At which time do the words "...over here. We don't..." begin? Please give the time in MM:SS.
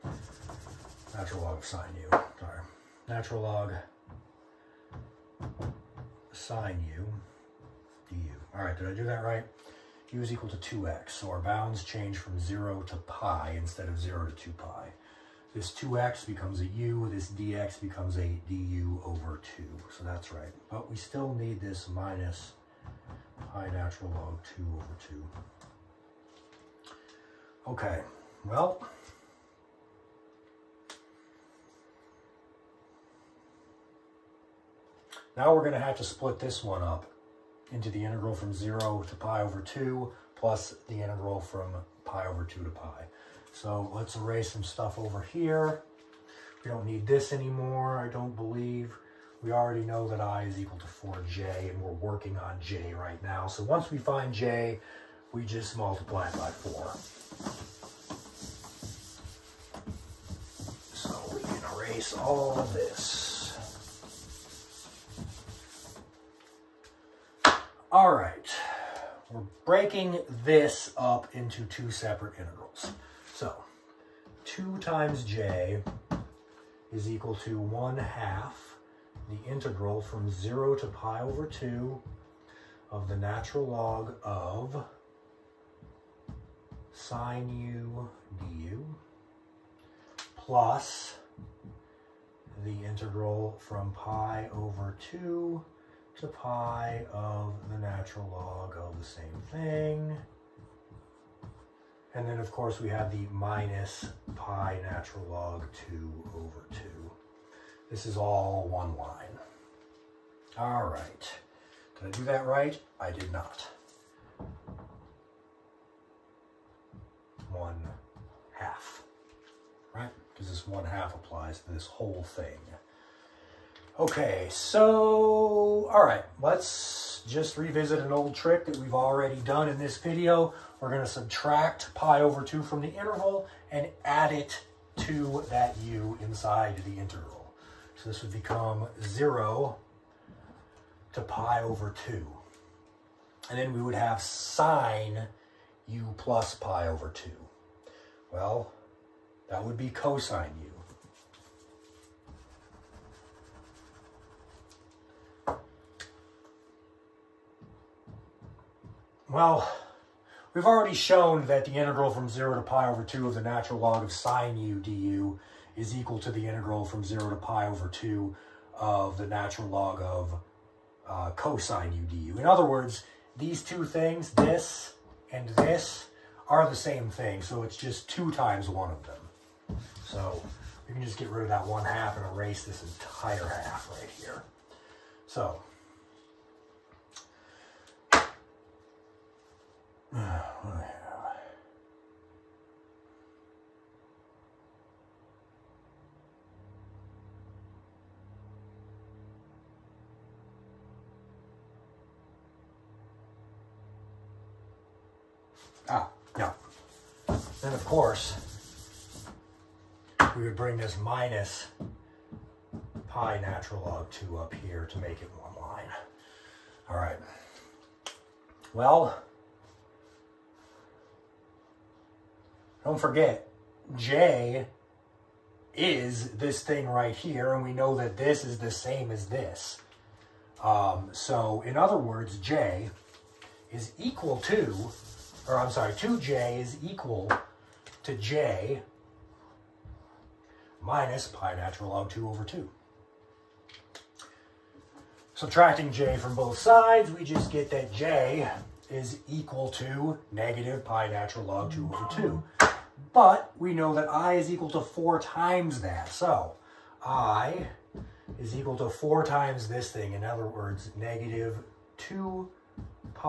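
00:44.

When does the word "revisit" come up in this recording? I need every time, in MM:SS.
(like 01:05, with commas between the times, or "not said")
02:07.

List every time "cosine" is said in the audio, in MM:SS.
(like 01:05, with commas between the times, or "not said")
02:29, 02:51.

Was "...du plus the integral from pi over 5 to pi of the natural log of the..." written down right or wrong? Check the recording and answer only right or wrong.
wrong.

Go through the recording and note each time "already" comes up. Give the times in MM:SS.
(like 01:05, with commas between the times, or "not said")
00:49, 02:08, 02:40.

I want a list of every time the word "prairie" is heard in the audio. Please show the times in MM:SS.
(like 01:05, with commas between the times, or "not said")
not said.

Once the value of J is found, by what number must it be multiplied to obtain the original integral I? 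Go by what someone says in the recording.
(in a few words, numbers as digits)
4.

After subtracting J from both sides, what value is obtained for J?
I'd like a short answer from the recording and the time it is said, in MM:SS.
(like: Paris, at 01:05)
-pi ln 2 / 2, at 04:10.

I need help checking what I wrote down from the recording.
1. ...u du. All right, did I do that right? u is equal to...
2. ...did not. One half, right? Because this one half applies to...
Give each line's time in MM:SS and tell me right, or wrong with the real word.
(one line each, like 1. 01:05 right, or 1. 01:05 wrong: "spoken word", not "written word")
1. 00:06 right
2. 01:53 right.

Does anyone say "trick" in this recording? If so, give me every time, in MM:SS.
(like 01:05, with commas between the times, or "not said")
02:08.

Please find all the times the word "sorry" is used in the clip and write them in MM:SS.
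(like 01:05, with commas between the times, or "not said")
00:02, 03:55.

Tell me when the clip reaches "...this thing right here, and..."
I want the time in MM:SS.
03:46.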